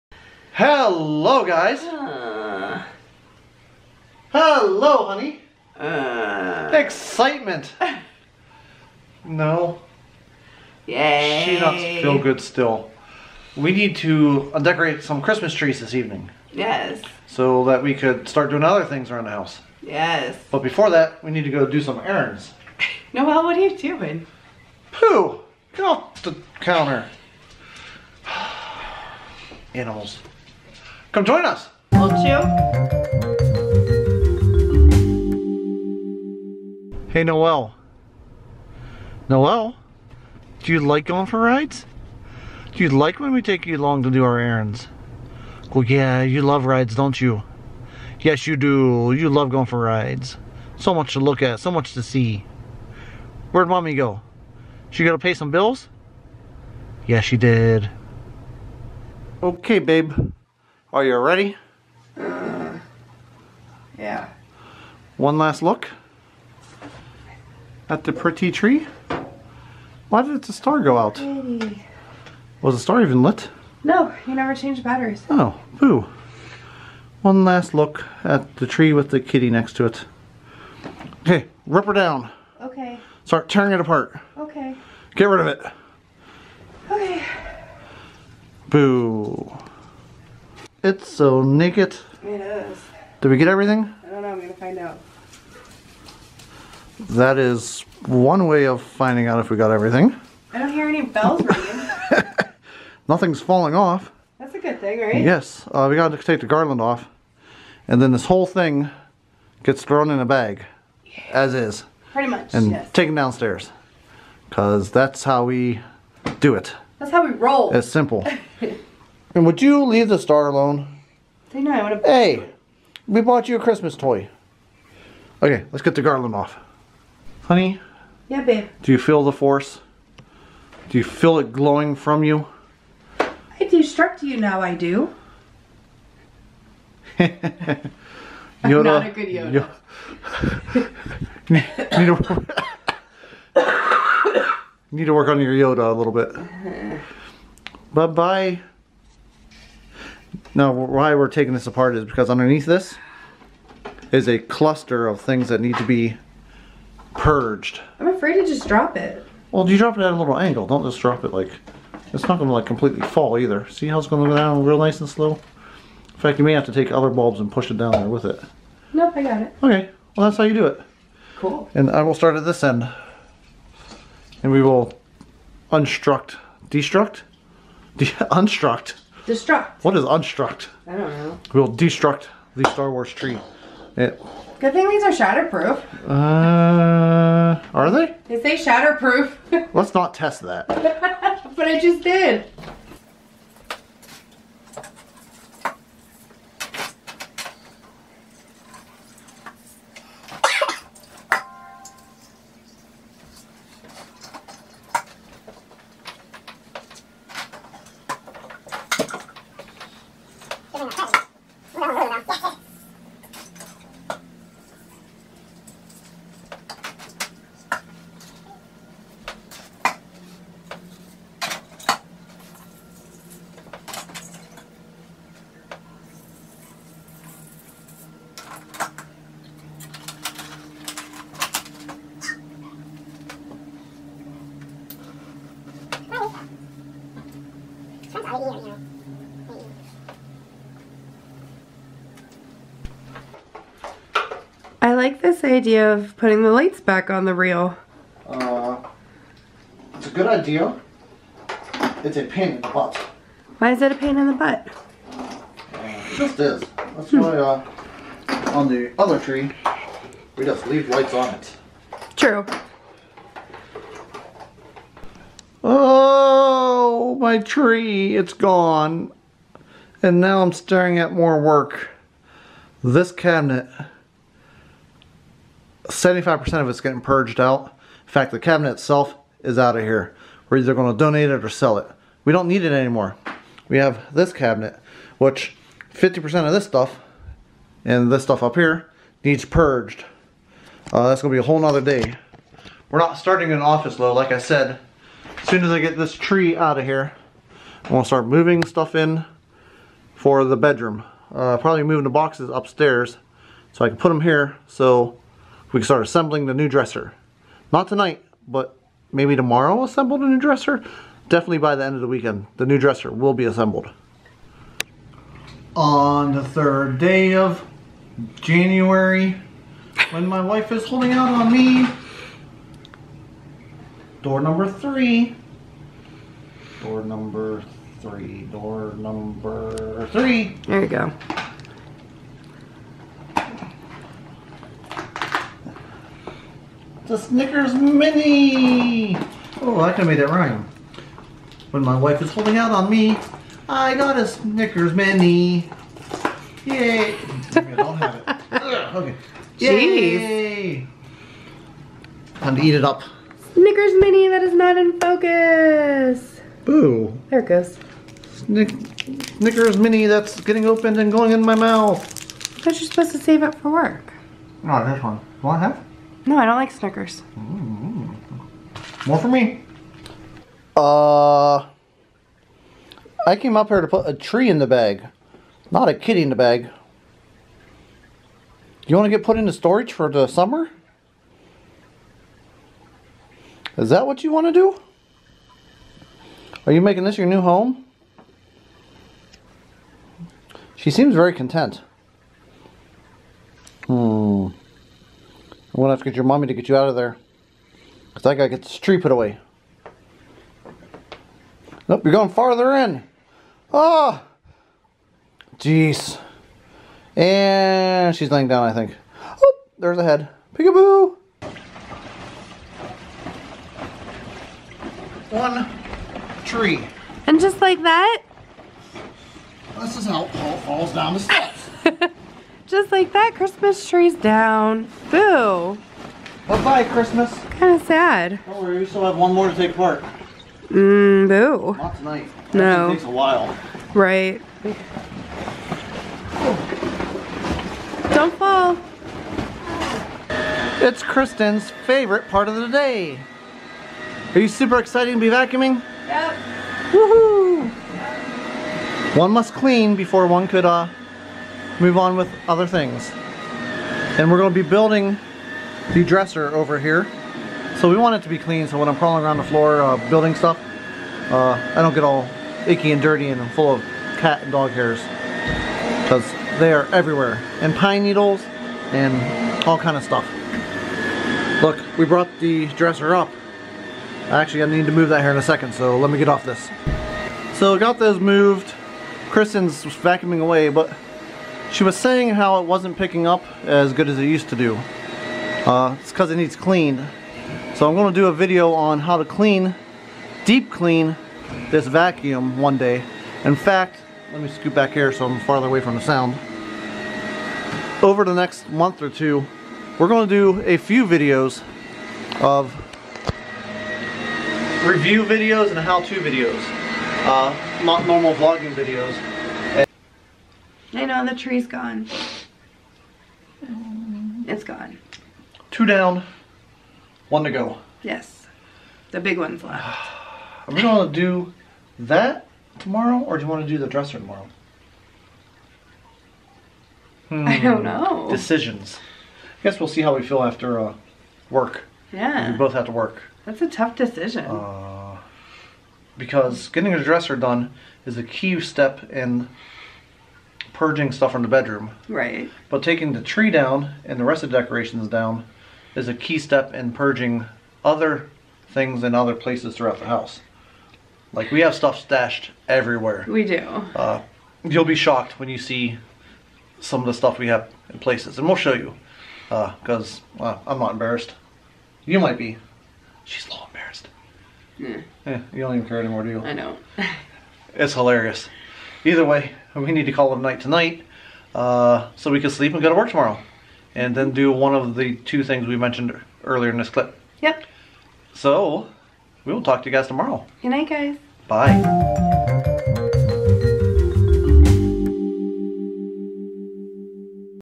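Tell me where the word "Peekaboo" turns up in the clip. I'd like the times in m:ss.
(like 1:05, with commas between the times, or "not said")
6:50.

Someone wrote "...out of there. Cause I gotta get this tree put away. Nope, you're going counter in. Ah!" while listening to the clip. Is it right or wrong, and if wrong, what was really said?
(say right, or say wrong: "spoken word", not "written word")
wrong: "farther", not "counter".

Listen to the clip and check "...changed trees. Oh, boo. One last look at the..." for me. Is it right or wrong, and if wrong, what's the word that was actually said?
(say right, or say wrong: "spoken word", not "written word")
wrong: "batteries", not "trees".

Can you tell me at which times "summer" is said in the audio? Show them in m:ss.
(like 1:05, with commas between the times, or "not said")
6:20.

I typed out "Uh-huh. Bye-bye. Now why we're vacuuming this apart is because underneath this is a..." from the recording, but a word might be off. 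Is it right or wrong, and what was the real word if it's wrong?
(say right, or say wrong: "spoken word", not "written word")
wrong: "taking", not "vacuuming".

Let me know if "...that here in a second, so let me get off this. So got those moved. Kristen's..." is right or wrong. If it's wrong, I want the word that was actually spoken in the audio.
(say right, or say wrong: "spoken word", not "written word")
right.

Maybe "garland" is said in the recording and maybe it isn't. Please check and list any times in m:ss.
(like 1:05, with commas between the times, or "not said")
1:46, 2:06.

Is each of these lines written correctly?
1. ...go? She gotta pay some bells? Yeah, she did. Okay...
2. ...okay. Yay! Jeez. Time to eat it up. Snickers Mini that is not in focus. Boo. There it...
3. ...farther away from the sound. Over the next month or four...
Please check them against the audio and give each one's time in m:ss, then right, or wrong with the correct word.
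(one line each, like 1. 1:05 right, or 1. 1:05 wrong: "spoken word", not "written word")
1. 0:53 wrong: "bills", not "bells"
2. 5:48 right
3. 8:15 wrong: "two", not "four".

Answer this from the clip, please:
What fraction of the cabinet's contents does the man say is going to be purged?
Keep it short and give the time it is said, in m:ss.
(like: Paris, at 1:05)
75%, at 4:35.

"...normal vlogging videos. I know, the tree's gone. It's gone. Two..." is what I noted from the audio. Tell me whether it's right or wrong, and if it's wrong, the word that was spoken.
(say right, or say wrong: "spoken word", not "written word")
right.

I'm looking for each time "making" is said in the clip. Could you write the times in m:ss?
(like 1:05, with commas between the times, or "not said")
6:26.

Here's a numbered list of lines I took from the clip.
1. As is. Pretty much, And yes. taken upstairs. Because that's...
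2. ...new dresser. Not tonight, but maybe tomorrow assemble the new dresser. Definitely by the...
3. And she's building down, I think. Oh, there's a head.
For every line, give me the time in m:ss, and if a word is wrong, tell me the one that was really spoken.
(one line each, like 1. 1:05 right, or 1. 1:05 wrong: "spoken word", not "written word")
1. 1:51 wrong: "downstairs", not "upstairs"
2. 5:06 right
3. 6:47 wrong: "laying", not "building".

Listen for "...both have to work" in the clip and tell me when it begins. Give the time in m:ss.
8:52.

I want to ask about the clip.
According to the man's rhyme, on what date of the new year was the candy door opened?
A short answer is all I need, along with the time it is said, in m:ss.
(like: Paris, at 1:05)
January 3, at 5:16.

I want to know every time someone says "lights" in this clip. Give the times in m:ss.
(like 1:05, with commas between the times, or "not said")
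4:06, 4:20.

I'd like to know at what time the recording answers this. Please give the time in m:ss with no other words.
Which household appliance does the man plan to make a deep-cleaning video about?
8:11.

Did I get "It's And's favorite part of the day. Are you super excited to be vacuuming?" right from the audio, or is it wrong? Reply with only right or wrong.
wrong.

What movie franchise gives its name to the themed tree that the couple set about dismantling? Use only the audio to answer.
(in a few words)
Star Wars.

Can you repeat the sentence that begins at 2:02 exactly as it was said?
Hey, we bought you a Christmas toy.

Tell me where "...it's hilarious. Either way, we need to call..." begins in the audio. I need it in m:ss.
9:27.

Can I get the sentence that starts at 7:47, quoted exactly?
And pine needles and all kind of stuff.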